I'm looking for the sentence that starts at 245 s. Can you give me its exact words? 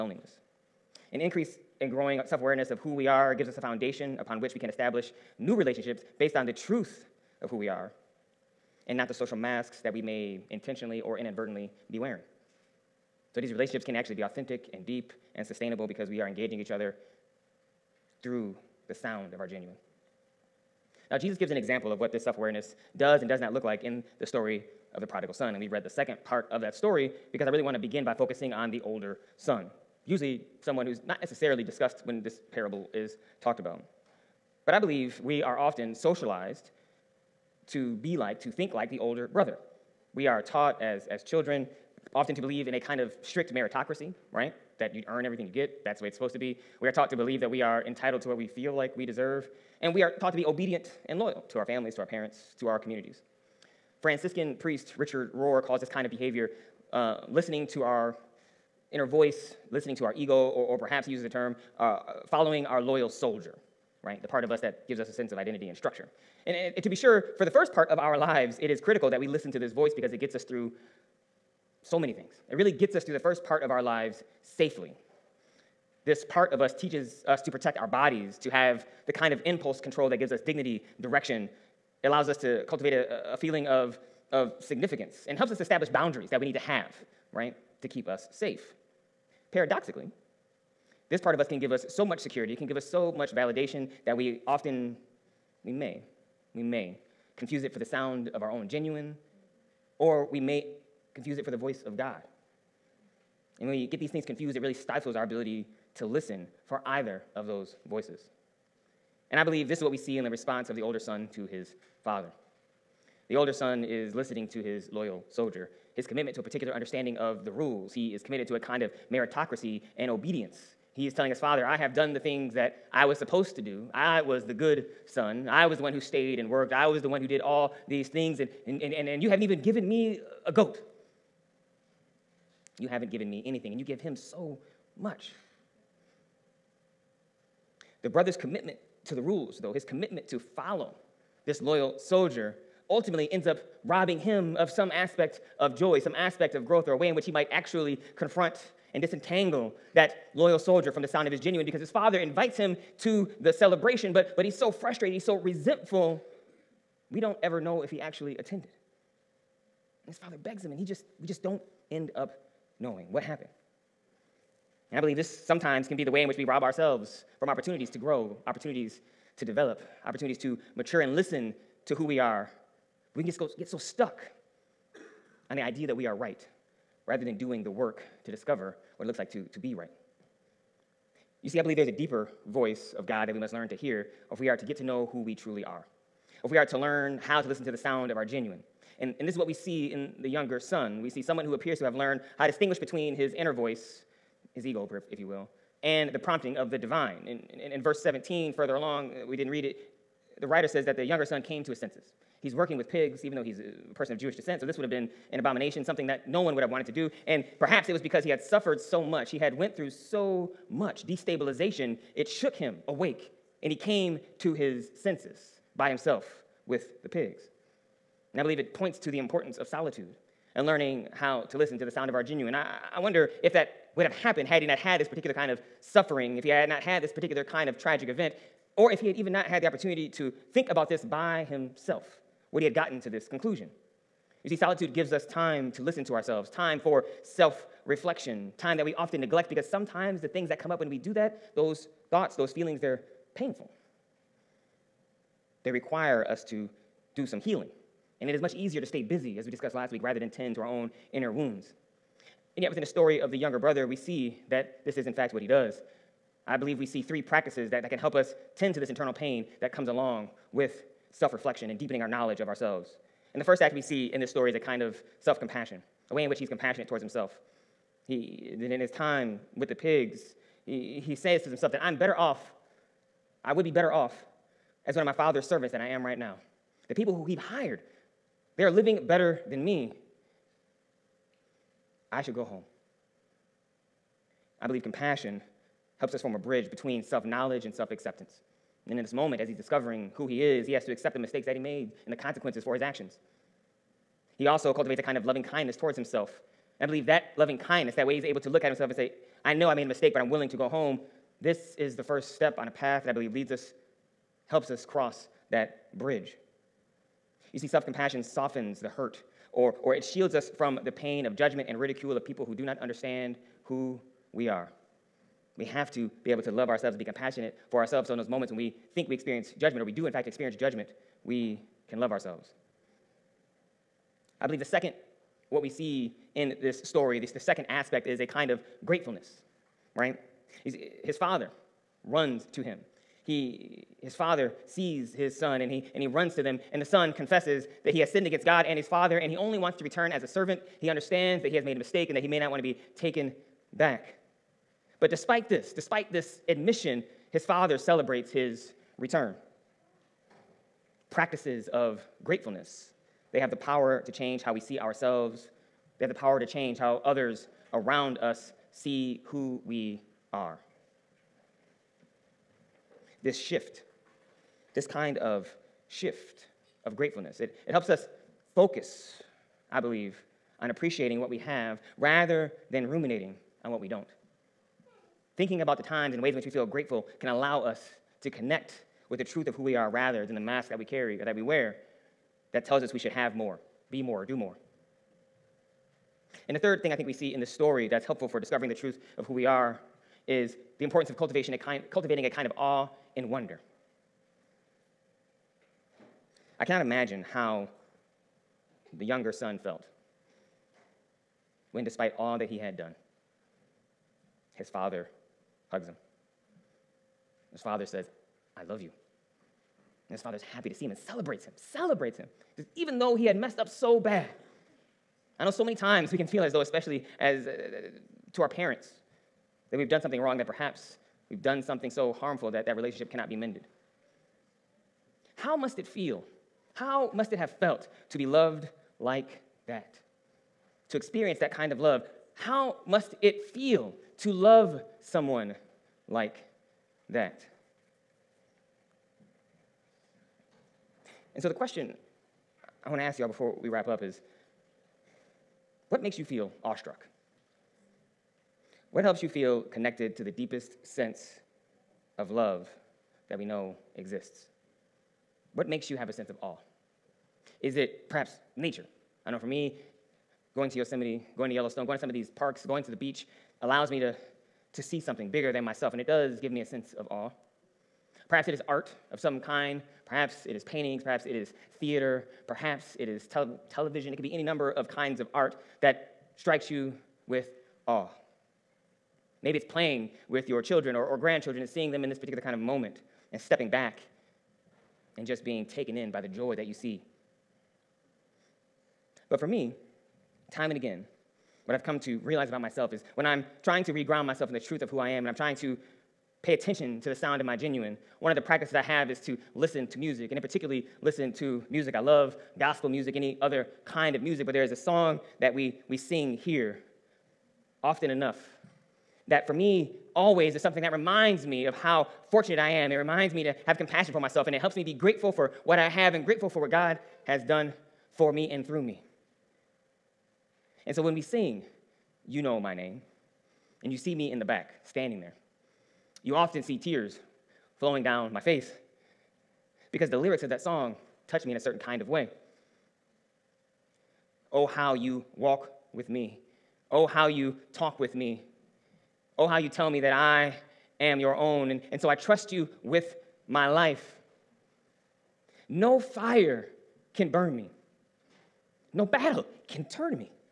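They require us to do some healing.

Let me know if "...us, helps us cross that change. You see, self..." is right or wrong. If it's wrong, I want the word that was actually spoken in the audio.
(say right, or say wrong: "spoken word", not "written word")
wrong: "bridge", not "change".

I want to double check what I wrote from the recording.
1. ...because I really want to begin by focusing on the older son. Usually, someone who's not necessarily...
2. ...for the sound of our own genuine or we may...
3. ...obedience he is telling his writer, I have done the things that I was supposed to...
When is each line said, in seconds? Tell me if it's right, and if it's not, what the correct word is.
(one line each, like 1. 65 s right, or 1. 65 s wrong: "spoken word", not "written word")
1. 27 s right
2. 97 s right
3. 120 s wrong: "father", not "writer".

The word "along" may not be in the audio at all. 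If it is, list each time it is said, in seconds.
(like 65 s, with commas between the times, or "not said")
198 s, 259 s.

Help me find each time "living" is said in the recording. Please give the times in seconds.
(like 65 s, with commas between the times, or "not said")
278 s.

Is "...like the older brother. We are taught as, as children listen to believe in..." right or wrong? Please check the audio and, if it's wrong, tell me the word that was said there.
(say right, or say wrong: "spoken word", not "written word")
wrong: "often", not "listen".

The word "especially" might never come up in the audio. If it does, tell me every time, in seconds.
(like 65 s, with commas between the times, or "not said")
416 s.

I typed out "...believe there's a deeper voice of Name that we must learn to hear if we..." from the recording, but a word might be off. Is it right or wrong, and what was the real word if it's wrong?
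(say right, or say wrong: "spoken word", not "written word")
wrong: "God", not "Name".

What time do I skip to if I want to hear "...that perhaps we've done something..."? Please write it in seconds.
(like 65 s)
420 s.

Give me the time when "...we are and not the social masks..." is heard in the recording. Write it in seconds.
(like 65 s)
7 s.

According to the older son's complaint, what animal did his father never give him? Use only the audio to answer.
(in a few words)
a goat.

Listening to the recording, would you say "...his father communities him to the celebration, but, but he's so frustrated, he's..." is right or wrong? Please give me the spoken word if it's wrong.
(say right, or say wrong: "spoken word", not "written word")
wrong: "invites", not "communities".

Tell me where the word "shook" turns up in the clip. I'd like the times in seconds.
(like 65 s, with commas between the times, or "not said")
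212 s.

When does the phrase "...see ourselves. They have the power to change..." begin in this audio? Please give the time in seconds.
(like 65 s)
354 s.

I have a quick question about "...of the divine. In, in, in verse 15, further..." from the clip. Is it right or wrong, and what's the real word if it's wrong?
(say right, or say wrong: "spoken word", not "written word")
wrong: "17", not "15".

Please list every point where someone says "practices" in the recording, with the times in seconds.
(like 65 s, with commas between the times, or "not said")
257 s, 351 s, 498 s.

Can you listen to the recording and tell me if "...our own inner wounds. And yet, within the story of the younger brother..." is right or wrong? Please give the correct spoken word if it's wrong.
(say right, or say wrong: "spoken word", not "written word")
right.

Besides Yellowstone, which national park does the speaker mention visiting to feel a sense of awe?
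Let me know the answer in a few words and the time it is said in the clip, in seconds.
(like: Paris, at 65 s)
Yosemite, at 460 s.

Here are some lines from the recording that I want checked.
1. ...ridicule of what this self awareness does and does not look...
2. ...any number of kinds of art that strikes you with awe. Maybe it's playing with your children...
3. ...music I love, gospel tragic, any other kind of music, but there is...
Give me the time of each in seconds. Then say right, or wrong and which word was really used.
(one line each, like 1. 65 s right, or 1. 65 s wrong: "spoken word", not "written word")
1. 21 s wrong: "example", not "ridicule"
2. 474 s right
3. 501 s wrong: "music", not "tragic".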